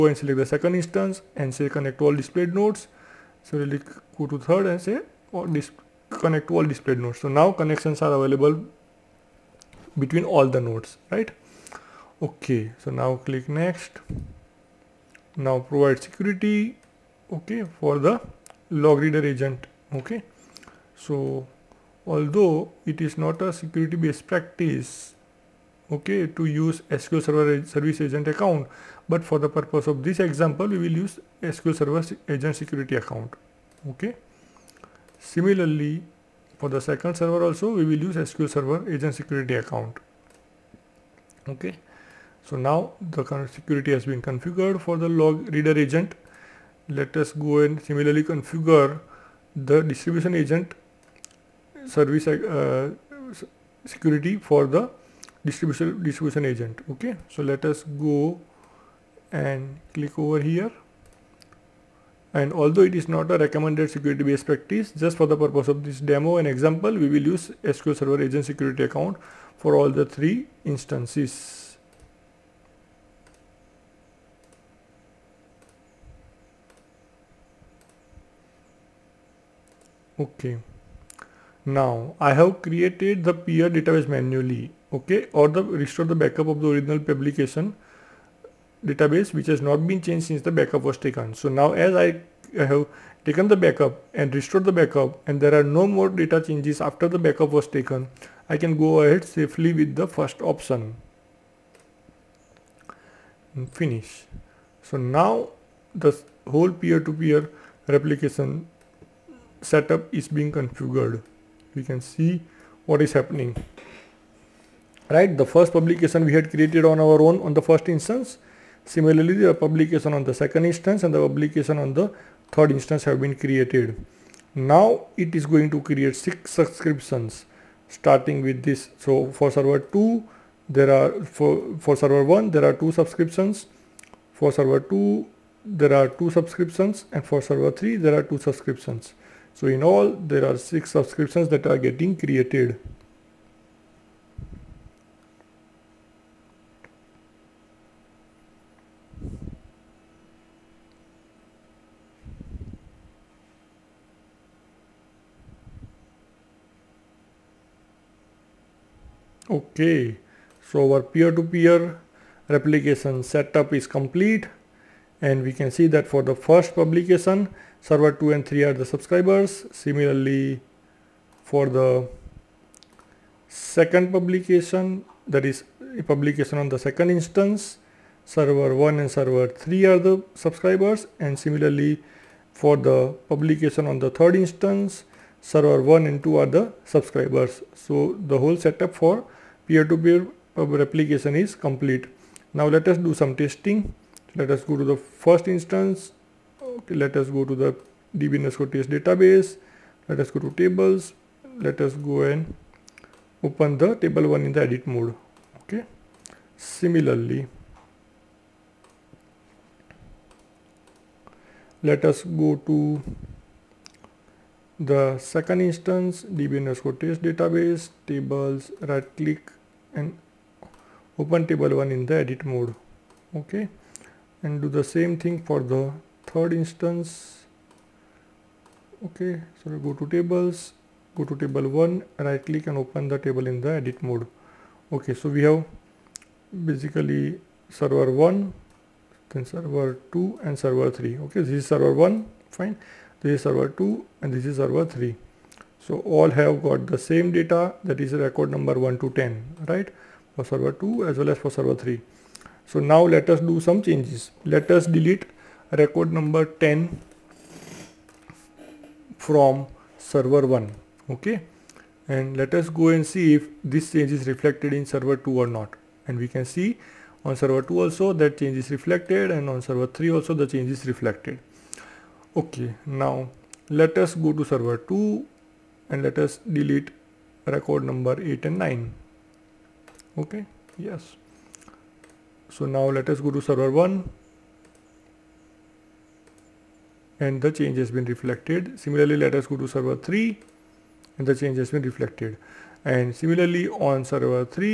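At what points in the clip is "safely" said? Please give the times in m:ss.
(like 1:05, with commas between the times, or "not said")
1:39.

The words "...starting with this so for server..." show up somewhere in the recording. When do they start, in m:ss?
2:07.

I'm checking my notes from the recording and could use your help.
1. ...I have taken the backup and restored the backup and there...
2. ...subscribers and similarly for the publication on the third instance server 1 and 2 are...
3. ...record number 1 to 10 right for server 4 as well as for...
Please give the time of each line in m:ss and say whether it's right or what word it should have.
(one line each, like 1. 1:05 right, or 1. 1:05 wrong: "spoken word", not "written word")
1. 1:31 right
2. 3:00 right
3. 4:08 wrong: "2", not "4".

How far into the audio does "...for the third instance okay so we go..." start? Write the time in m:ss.
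3:45.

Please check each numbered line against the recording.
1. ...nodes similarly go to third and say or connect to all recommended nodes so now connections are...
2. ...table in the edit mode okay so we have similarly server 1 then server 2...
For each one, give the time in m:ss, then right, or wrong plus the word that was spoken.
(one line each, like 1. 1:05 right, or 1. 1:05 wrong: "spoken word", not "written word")
1. 0:02 wrong: "displayed", not "recommended"
2. 3:53 wrong: "basically", not "similarly".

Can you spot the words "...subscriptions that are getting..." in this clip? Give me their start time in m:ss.
2:20.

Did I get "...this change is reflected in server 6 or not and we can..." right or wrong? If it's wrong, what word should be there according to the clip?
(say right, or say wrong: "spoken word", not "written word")
wrong: "2", not "6".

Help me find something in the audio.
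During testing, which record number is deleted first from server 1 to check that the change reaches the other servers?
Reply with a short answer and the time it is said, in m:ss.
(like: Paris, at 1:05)
10, at 4:15.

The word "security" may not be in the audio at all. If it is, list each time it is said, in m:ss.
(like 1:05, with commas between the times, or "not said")
0:16, 0:23, 0:32, 0:39, 0:43, 0:53, 1:03, 1:08.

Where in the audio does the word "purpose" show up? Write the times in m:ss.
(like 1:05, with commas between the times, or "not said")
0:29, 1:05.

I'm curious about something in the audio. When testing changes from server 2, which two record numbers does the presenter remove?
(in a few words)
8 and 9.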